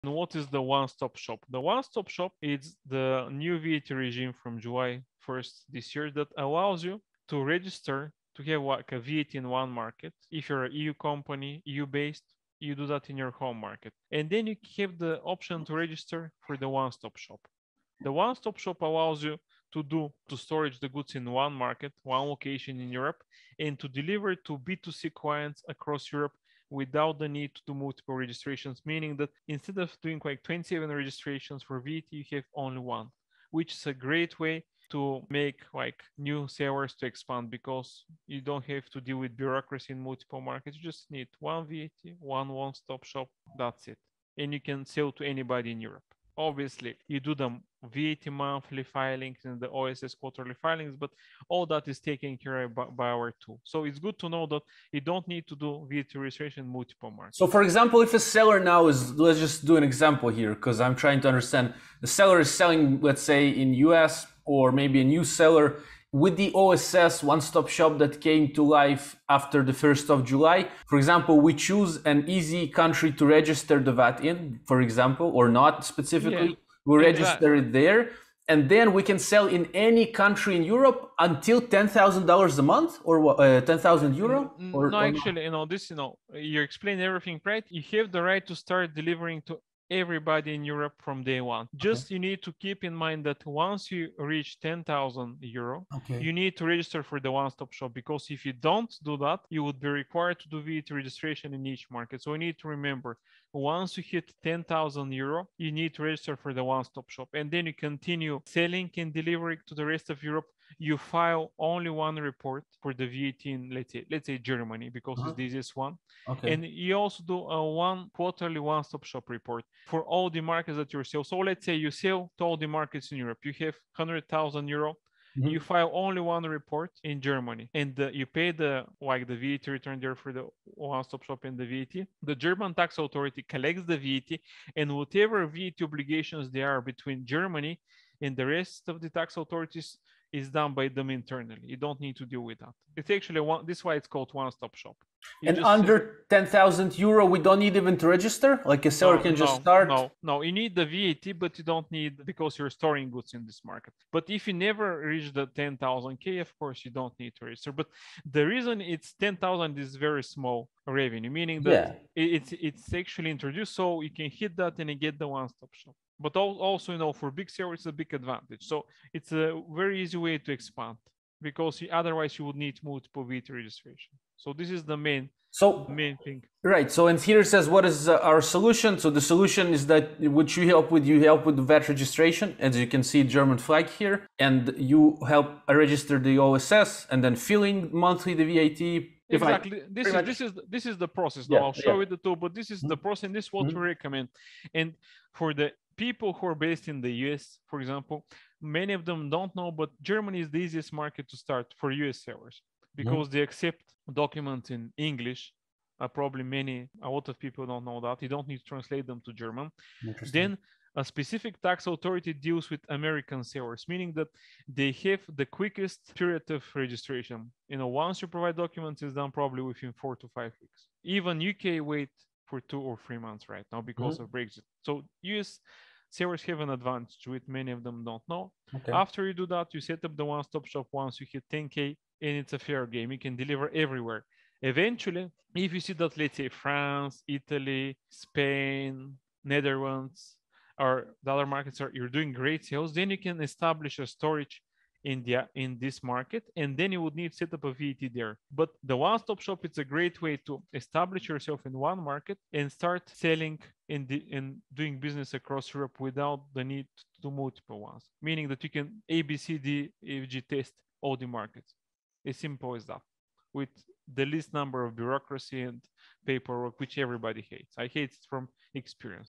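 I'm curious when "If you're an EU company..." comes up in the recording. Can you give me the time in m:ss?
0:10.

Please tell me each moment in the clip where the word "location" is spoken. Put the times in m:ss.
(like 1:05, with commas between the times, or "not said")
0:22.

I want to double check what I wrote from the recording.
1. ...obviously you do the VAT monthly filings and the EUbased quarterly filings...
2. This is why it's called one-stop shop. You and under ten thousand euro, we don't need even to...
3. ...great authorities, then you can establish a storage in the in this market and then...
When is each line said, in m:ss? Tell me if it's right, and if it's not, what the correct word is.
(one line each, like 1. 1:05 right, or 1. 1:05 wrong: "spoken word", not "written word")
1. 0:46 wrong: "OSS", not "EUbased"
2. 2:23 right
3. 4:02 wrong: "sales", not "authorities".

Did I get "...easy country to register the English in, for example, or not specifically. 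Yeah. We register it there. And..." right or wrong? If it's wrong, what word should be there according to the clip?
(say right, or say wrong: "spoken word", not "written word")
wrong: "VAT", not "English".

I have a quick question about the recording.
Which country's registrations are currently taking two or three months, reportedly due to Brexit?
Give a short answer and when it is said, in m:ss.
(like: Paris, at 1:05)
UK, at 3:41.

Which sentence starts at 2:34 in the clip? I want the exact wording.
But if you never reach the ten thousand k, of course you don't need to register.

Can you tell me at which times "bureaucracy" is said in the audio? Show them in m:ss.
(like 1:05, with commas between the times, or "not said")
0:39, 4:24.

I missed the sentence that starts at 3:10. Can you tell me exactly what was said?
this is this is the process yeah, i'll show yeah.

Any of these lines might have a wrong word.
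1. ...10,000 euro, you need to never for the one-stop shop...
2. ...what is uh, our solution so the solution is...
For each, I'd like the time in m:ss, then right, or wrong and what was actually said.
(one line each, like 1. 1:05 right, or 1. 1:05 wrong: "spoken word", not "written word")
1. 1:44 wrong: "register", not "never"
2. 2:57 right.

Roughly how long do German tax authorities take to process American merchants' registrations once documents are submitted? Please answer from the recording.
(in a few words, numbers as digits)
4 to 5 weeks.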